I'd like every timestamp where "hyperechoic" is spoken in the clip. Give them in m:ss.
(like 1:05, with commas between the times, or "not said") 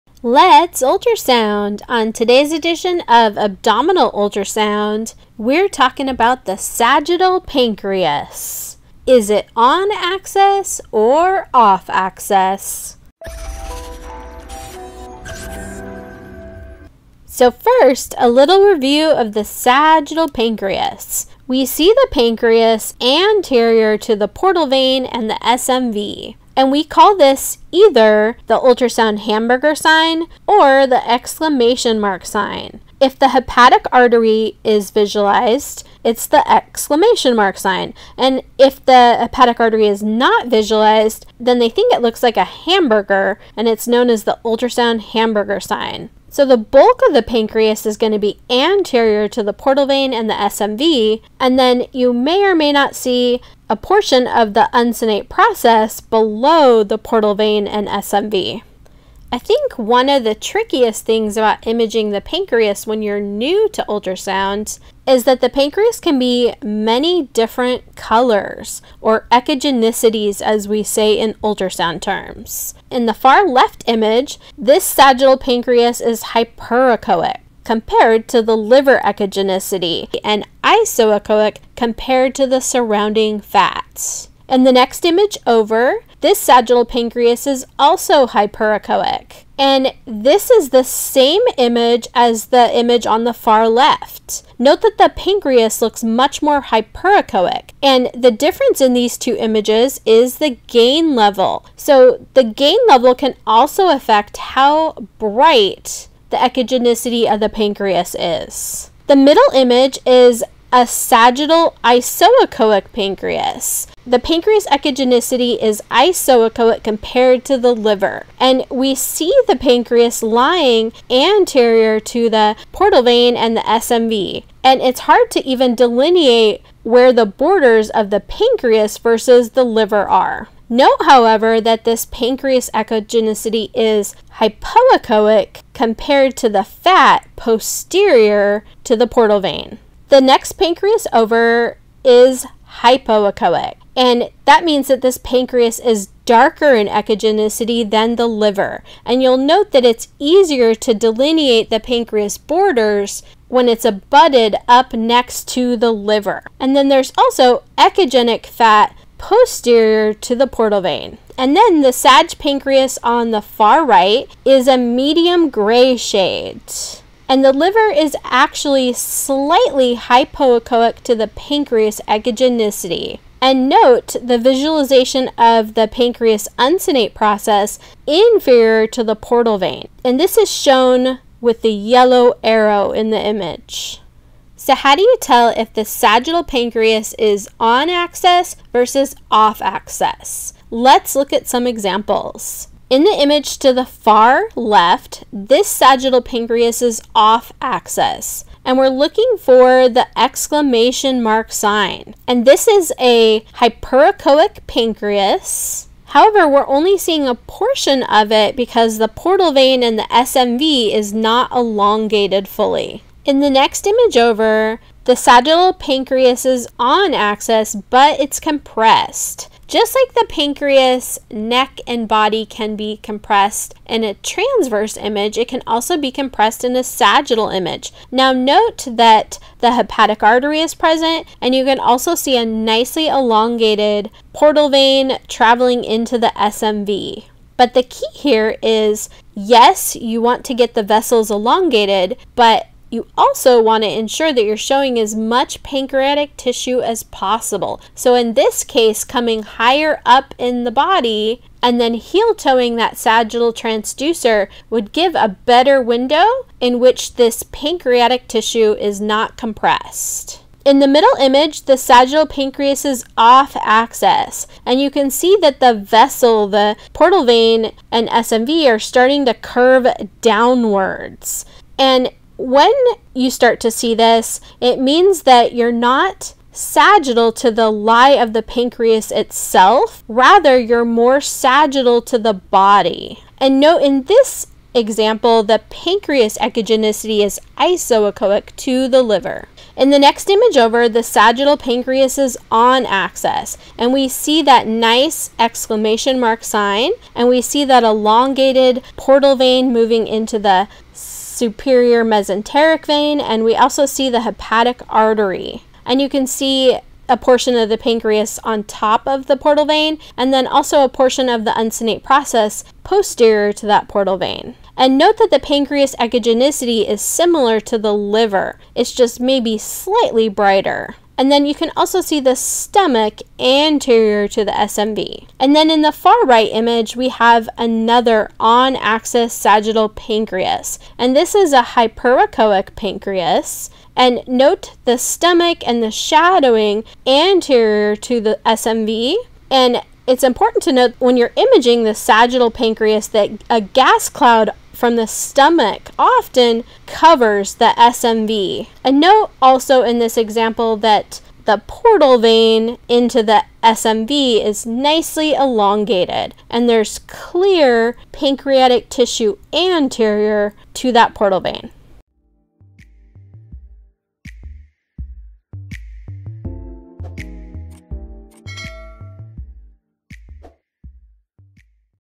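1:16, 1:28, 1:36, 3:23, 5:31.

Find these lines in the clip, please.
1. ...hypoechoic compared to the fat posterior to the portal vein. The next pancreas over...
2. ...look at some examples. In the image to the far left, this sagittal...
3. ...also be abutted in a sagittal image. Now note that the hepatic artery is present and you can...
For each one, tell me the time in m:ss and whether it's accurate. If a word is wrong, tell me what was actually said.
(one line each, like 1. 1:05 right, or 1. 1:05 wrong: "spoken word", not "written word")
1. 2:14 right
2. 3:11 right
3. 3:45 wrong: "compressed", not "abutted".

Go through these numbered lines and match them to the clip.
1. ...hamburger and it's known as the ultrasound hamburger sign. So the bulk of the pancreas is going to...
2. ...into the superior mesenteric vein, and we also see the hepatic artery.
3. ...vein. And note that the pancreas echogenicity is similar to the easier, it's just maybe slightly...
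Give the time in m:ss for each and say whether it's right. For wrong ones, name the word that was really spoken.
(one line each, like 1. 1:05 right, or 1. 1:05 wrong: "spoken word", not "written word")
1. 0:42 right
2. 5:00 right
3. 5:14 wrong: "liver", not "easier".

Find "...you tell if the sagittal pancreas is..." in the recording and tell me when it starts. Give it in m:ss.
3:05.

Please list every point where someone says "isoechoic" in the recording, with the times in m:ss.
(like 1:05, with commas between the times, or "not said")
1:20, 1:51, 1:55, 4:47.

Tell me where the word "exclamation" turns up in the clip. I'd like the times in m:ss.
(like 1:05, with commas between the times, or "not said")
0:31, 0:36, 3:20, 4:55.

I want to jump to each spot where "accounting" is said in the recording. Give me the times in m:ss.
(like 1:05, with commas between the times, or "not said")
not said.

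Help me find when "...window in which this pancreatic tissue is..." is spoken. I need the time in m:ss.
4:15.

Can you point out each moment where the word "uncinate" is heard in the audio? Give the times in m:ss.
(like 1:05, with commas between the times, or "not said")
0:54, 2:56, 5:11.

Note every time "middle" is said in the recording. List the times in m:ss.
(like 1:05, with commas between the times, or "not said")
1:49, 4:20.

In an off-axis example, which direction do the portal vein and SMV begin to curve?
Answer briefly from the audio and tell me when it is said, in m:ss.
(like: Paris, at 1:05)
downwards, at 4:30.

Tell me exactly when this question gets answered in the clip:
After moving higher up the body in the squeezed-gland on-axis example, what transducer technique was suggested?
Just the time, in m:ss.
4:11.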